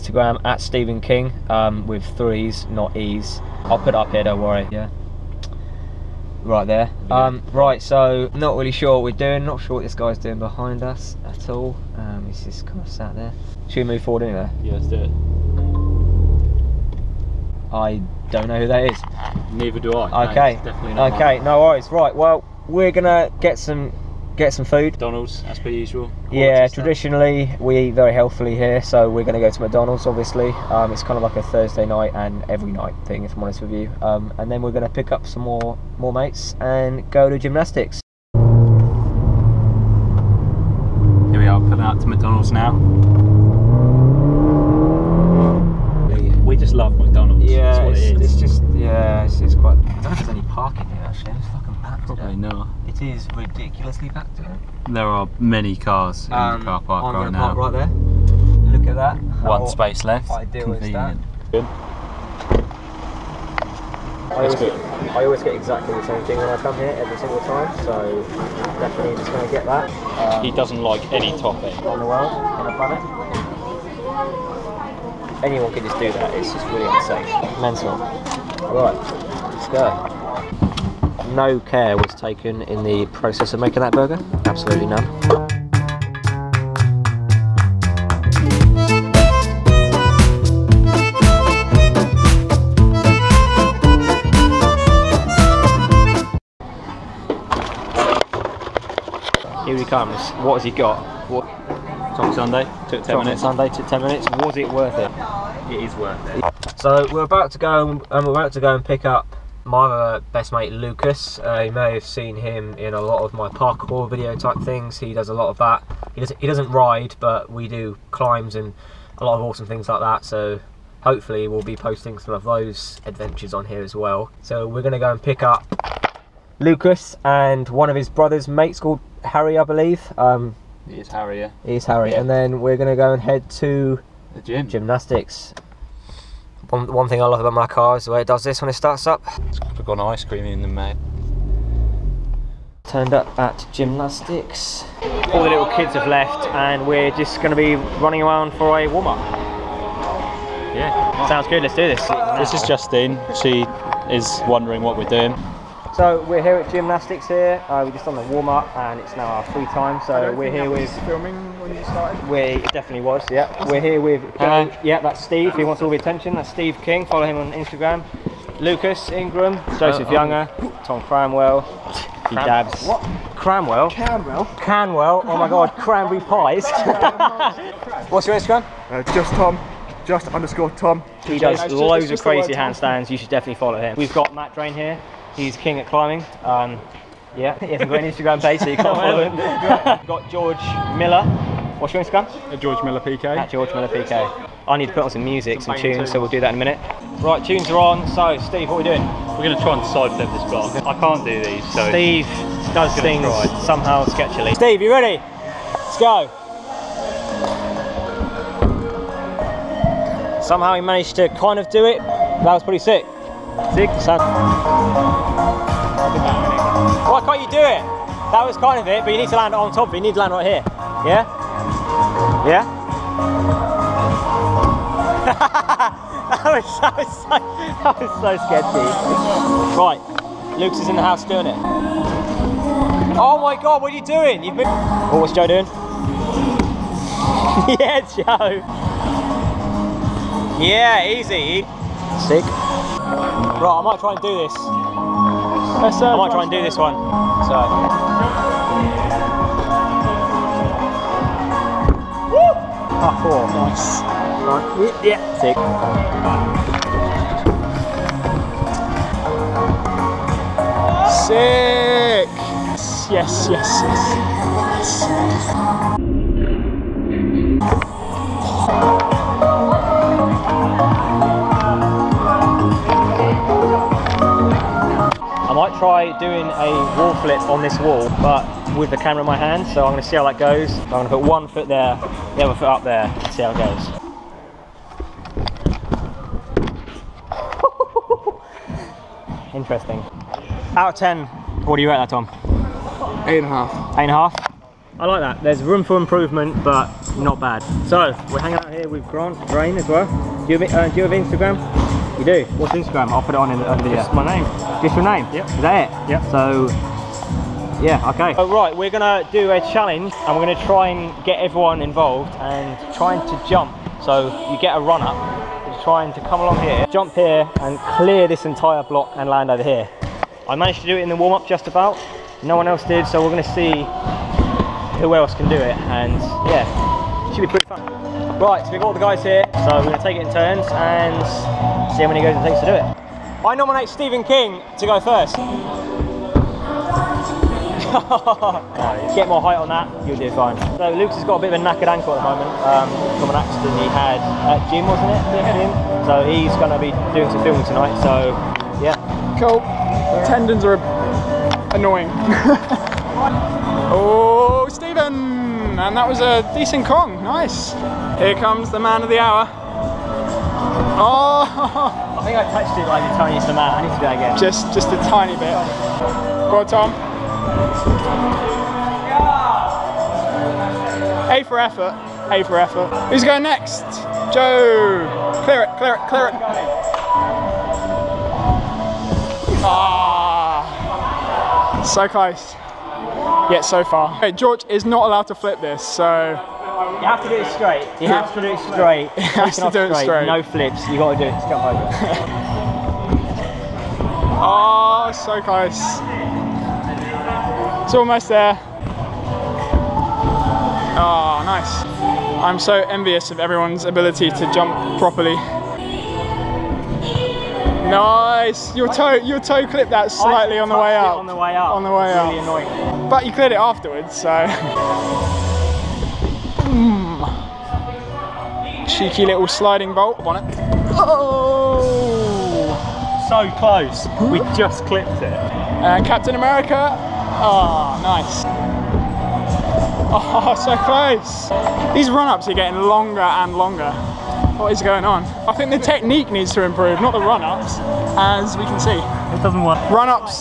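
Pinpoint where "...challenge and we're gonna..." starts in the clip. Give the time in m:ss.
5:09.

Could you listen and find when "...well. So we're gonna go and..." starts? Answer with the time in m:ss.
2:03.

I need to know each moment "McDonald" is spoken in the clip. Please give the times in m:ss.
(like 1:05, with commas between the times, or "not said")
0:24, 0:29, 0:42.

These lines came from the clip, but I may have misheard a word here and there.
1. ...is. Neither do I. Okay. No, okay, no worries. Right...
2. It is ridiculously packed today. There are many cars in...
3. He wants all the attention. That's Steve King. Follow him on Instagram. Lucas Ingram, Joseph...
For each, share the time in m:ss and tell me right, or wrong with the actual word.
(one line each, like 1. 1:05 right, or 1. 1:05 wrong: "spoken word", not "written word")
1. 0:18 right
2. 0:52 right
3. 2:45 right.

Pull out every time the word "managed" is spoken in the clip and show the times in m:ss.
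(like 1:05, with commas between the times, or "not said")
3:30, 5:20.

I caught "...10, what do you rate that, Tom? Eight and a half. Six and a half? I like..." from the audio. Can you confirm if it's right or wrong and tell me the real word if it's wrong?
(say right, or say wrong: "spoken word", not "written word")
wrong: "Eight", not "Six".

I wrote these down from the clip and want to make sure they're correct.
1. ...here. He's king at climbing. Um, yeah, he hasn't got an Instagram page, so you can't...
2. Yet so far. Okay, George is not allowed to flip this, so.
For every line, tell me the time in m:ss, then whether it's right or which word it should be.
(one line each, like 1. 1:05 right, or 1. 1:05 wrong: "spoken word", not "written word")
1. 3:04 right
2. 6:23 right.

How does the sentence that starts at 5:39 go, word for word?
Get more height on that, you'll do fine.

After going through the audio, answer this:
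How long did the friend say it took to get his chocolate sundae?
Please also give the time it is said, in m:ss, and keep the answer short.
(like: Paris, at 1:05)
10 minutes, at 1:43.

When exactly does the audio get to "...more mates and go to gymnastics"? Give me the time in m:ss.
0:35.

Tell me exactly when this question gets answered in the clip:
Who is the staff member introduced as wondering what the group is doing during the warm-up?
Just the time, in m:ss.
2:32.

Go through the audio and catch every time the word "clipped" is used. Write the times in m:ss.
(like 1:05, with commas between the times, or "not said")
6:49, 7:04.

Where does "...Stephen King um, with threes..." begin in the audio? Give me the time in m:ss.
0:00.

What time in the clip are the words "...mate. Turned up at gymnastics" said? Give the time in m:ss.
2:20.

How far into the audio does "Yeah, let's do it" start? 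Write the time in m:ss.
0:14.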